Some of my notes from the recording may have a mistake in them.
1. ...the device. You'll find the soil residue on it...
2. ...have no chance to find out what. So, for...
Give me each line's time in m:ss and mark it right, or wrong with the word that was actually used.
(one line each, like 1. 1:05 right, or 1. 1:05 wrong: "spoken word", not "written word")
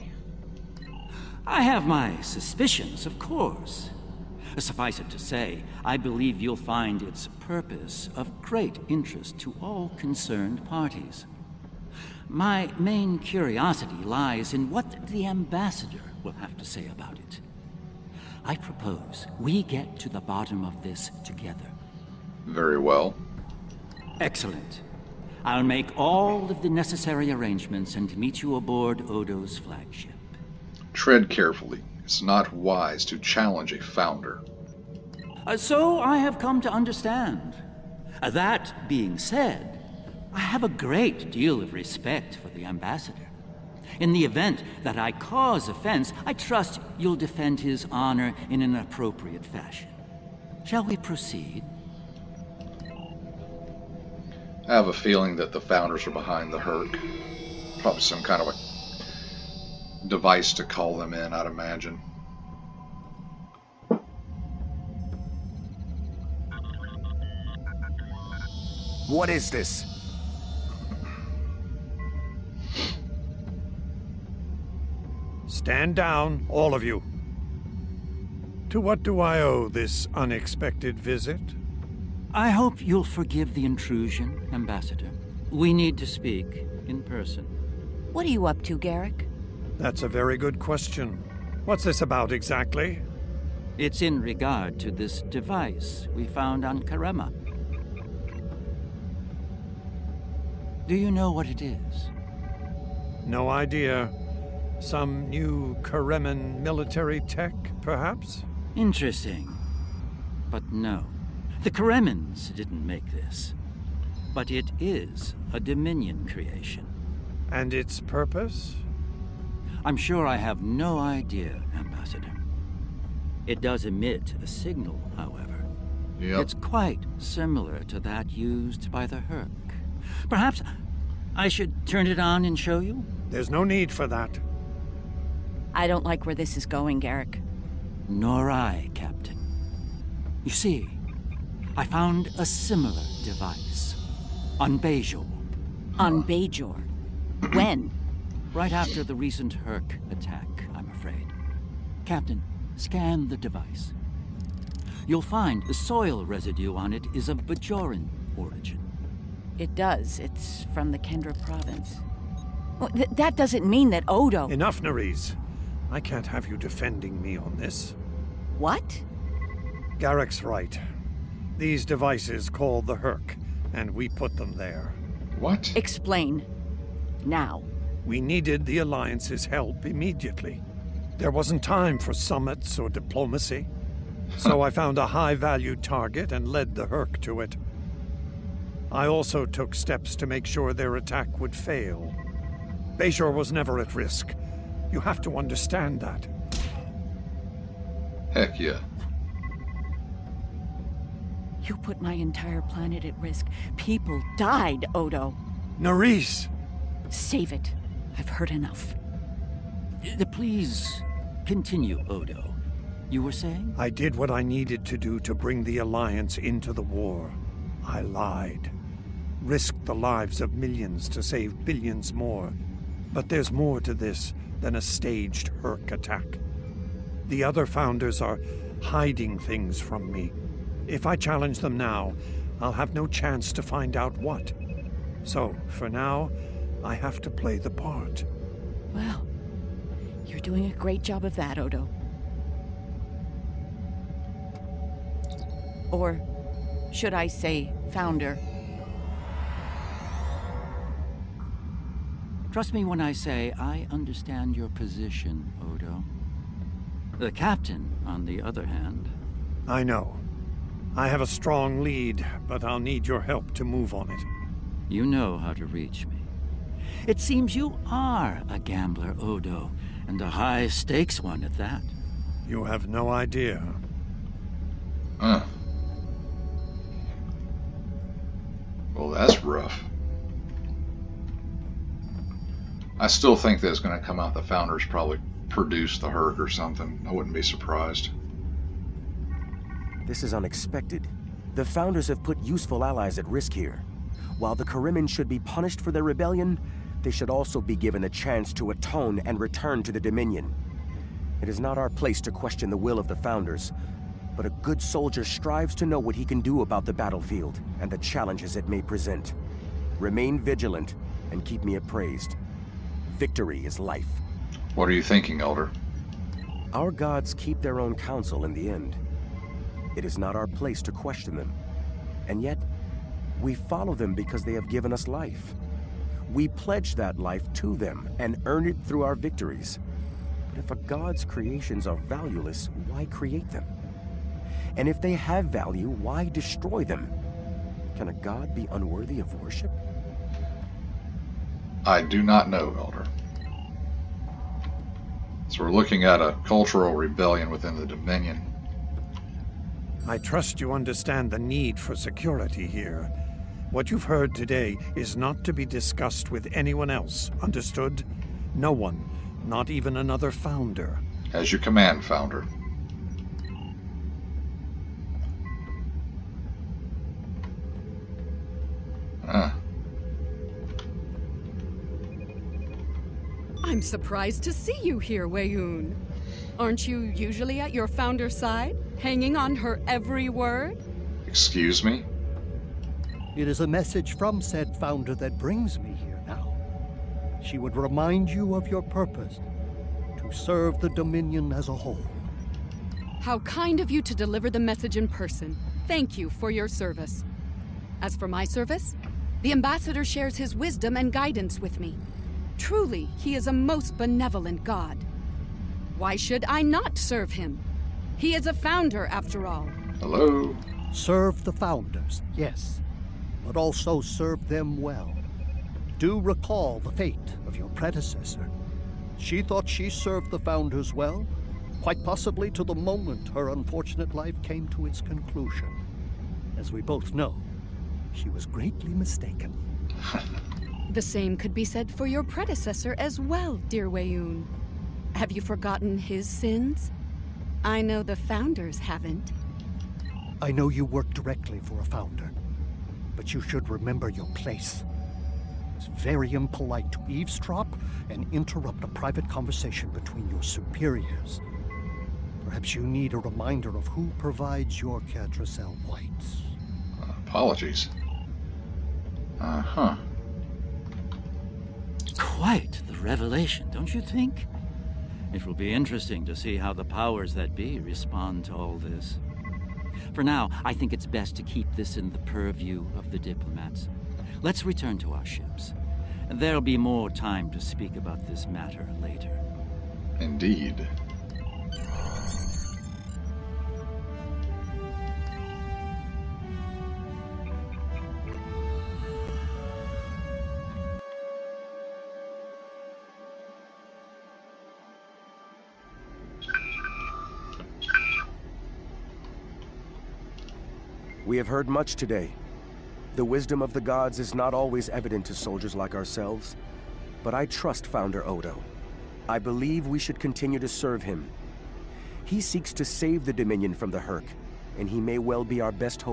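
1. 2:33 right
2. 3:52 right.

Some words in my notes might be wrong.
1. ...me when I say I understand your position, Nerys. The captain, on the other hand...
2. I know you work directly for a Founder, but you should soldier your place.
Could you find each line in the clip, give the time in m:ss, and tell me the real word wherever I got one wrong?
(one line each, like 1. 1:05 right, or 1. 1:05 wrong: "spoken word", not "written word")
1. 4:12 wrong: "Odo", not "Nerys"
2. 7:20 wrong: "remember", not "soldier".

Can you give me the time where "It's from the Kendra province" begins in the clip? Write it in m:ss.
2:40.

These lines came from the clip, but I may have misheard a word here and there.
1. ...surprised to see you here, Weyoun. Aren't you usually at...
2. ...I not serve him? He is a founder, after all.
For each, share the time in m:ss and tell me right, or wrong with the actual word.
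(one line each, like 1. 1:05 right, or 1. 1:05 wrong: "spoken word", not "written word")
1. 6:13 right
2. 6:46 right.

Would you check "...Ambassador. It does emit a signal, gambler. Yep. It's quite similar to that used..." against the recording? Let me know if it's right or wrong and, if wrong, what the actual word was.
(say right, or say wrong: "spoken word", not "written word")
wrong: "however", not "gambler".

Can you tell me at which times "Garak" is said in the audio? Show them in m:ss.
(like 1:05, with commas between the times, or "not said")
1:28, 2:17.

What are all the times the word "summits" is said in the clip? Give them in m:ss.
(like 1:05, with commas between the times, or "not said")
3:02.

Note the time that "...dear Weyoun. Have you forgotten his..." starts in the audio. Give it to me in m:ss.
7:13.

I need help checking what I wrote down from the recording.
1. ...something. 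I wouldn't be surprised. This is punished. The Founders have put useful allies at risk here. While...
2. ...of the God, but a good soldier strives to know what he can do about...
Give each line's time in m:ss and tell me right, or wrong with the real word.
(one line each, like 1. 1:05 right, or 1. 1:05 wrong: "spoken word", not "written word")
1. 4:46 wrong: "unexpected", not "punished"
2. 5:02 wrong: "Founders", not "God".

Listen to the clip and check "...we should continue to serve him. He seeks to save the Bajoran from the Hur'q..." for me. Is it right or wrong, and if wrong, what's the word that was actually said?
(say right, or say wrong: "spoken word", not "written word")
wrong: "Dominion", not "Bajoran".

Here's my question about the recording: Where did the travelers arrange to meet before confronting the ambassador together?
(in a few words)
Odo's flagship.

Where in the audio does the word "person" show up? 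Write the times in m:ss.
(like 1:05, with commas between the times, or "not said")
1:27, 6:35.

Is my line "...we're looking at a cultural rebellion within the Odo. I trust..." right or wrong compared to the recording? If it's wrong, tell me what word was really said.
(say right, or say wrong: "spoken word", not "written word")
wrong: "Dominion", not "Odo".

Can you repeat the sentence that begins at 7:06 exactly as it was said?
As we both know, she was greatly mistaken.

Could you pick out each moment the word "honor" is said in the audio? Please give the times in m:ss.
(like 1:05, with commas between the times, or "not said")
0:47.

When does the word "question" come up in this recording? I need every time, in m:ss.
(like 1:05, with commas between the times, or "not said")
1:30, 5:02, 5:20.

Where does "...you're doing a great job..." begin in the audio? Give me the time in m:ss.
4:00.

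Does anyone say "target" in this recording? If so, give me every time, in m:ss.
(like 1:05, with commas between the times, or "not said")
3:05.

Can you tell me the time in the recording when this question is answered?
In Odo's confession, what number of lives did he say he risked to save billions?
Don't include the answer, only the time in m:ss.
3:40.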